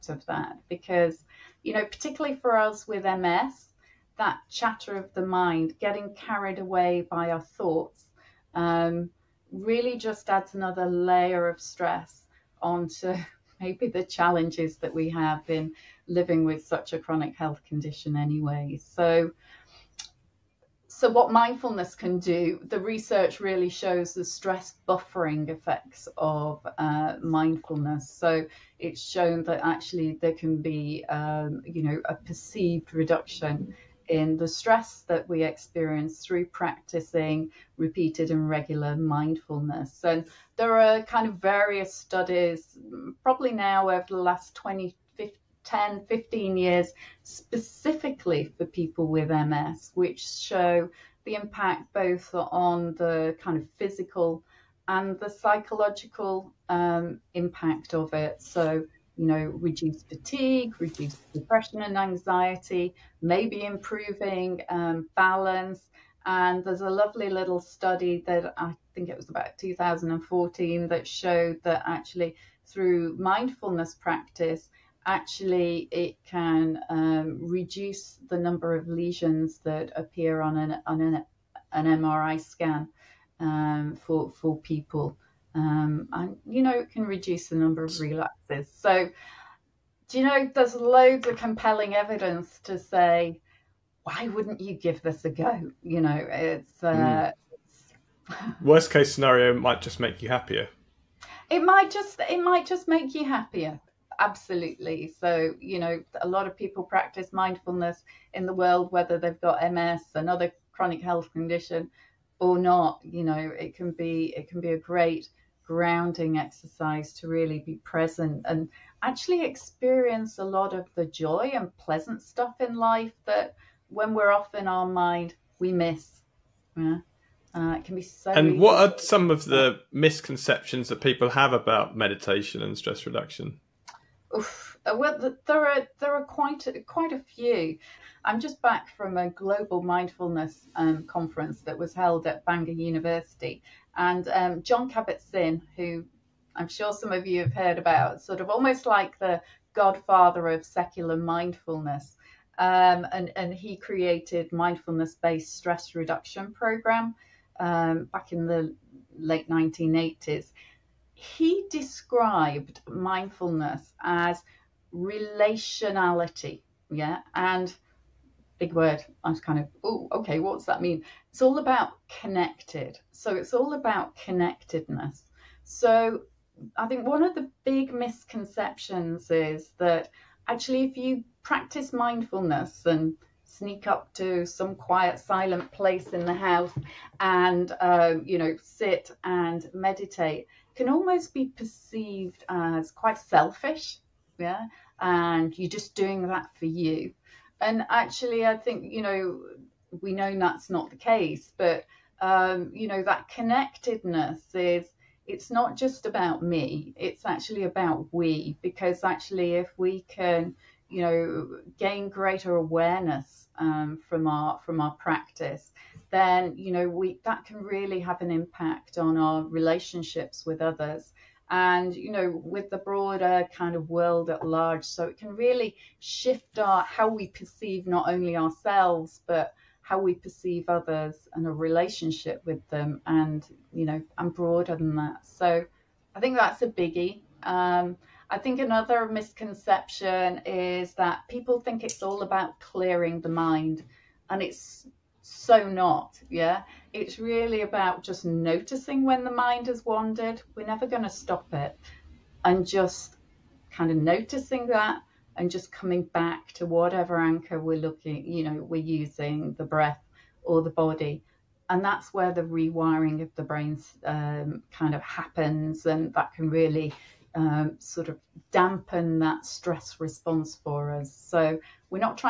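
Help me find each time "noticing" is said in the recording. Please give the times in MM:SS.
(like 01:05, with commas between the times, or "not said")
04:08, 04:13.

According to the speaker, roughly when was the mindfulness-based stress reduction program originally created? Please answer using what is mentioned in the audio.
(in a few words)
late 1980s.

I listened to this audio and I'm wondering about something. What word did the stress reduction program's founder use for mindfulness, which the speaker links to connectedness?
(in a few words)
relationality.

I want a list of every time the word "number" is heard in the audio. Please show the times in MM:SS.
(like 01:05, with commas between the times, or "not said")
01:18, 01:27.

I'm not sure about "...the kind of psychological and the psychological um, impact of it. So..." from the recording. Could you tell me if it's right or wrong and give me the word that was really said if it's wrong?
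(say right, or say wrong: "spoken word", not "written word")
wrong: "physical", not "psychological".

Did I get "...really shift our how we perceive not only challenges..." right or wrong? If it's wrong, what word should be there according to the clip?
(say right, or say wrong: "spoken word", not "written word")
wrong: "ourselves", not "challenges".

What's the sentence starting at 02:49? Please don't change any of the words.
I was kind of, oh, okay, what's that mean?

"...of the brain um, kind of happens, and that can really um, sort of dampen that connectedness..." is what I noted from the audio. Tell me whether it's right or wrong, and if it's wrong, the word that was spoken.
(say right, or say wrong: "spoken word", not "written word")
wrong: "stress", not "connectedness".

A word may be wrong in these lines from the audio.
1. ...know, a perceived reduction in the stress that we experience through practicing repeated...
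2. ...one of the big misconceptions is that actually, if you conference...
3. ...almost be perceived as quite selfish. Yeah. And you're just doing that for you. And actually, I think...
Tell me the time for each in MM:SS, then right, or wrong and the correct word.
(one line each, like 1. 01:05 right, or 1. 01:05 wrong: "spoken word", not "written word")
1. 00:31 right
2. 02:57 wrong: "practice", not "conference"
3. 03:10 right.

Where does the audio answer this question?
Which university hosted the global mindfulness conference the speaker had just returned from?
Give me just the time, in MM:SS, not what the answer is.
02:22.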